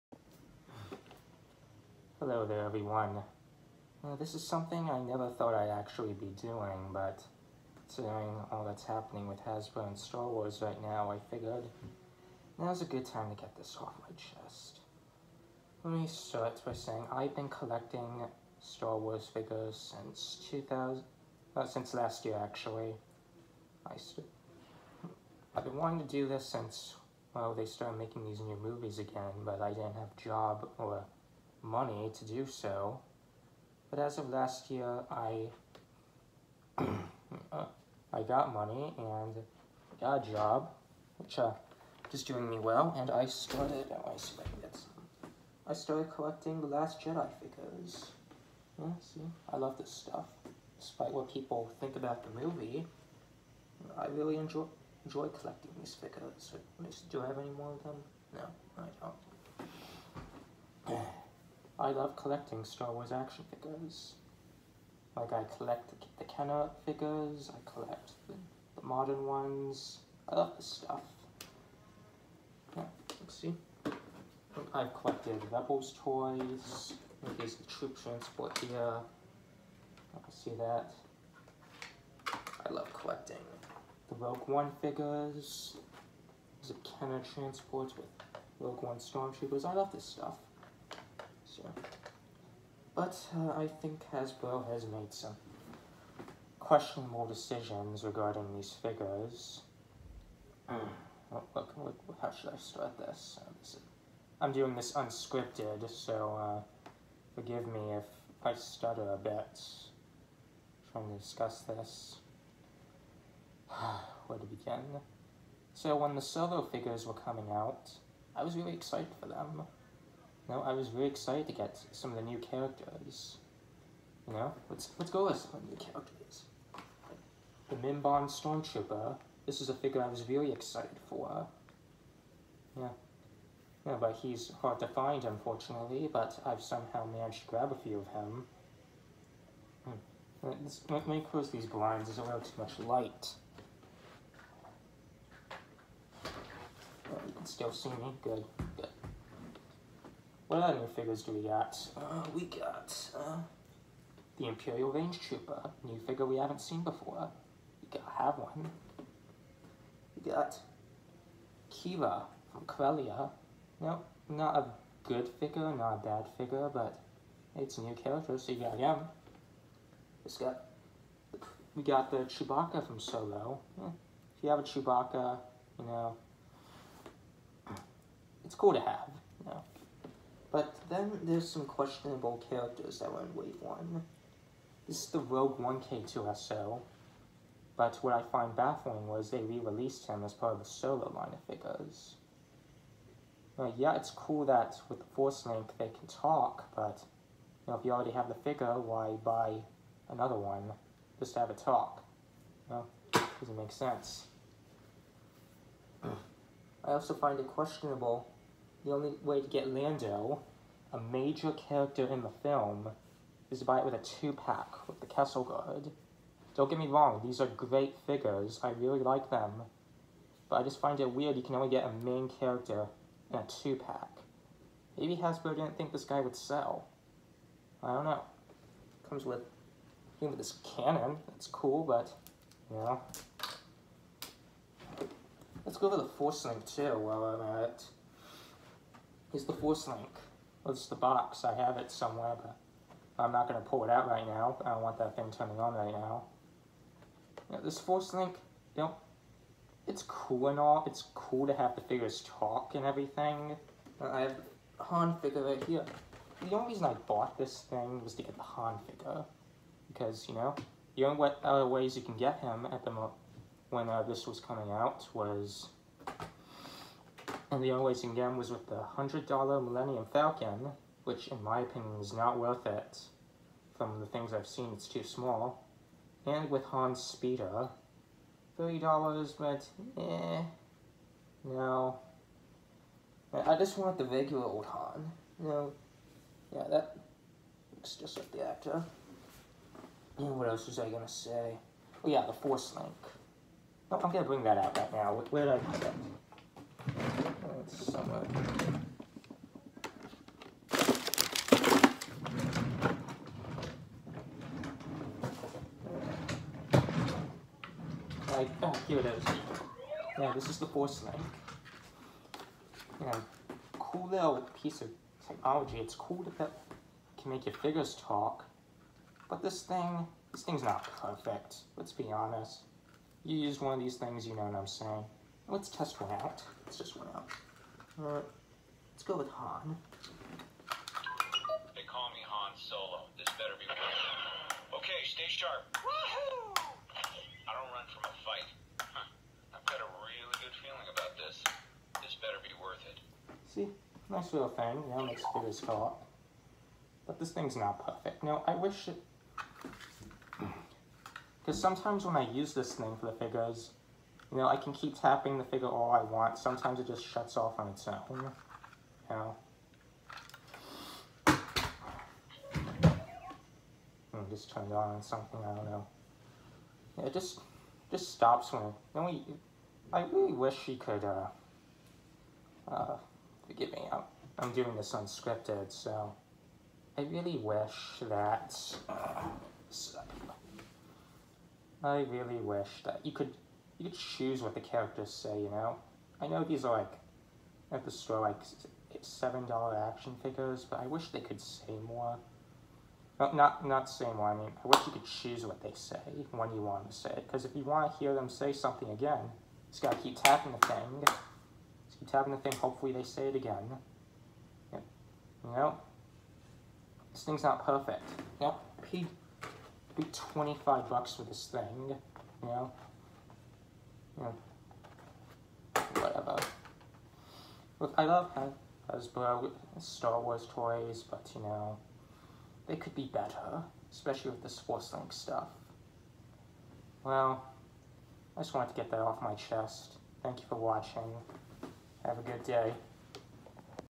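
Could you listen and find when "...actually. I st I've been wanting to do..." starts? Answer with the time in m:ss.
0:22.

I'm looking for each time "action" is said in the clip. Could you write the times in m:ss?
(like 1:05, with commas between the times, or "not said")
1:03, 6:29.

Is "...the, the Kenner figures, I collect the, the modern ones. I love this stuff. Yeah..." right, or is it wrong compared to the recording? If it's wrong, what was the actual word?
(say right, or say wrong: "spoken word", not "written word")
right.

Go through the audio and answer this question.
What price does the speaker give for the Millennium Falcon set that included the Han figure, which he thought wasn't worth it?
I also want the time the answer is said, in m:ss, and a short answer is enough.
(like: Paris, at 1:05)
$100, at 4:28.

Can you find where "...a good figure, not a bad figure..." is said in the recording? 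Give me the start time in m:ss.
2:44.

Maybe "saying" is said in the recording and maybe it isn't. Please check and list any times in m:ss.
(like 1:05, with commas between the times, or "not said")
0:16, 5:24.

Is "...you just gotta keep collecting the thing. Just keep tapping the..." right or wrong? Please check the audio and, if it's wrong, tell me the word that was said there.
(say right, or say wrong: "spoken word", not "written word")
wrong: "tapping", not "collecting".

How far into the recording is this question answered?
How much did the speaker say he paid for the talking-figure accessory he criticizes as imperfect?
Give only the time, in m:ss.
6:50.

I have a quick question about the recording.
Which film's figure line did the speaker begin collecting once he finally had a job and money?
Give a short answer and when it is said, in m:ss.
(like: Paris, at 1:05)
The Last Jedi, at 0:46.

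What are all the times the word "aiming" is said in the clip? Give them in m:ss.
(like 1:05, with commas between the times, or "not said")
not said.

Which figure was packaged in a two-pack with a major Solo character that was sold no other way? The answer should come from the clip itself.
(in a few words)
Kessel Guard.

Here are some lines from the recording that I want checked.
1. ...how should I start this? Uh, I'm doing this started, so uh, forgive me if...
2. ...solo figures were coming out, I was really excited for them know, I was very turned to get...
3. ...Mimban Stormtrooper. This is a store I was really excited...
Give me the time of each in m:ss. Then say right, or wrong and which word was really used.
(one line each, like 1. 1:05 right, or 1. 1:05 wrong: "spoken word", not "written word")
1. 1:42 wrong: "unscripted", not "started"
2. 1:56 wrong: "excited", not "turned"
3. 2:07 wrong: "figure", not "store".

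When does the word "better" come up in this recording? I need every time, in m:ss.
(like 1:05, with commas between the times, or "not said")
5:33, 5:42, 7:03.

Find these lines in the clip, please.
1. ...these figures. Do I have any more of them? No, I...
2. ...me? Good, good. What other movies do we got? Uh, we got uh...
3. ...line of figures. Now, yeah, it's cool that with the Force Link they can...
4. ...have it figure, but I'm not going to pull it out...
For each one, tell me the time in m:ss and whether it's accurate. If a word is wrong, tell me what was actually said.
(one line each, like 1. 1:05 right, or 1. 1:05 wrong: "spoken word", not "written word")
1. 0:55 right
2. 2:27 wrong: "figures", not "movies"
3. 3:11 right
4. 4:01 wrong: "somewhere", not "figure".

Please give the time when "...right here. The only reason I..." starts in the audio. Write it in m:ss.
4:15.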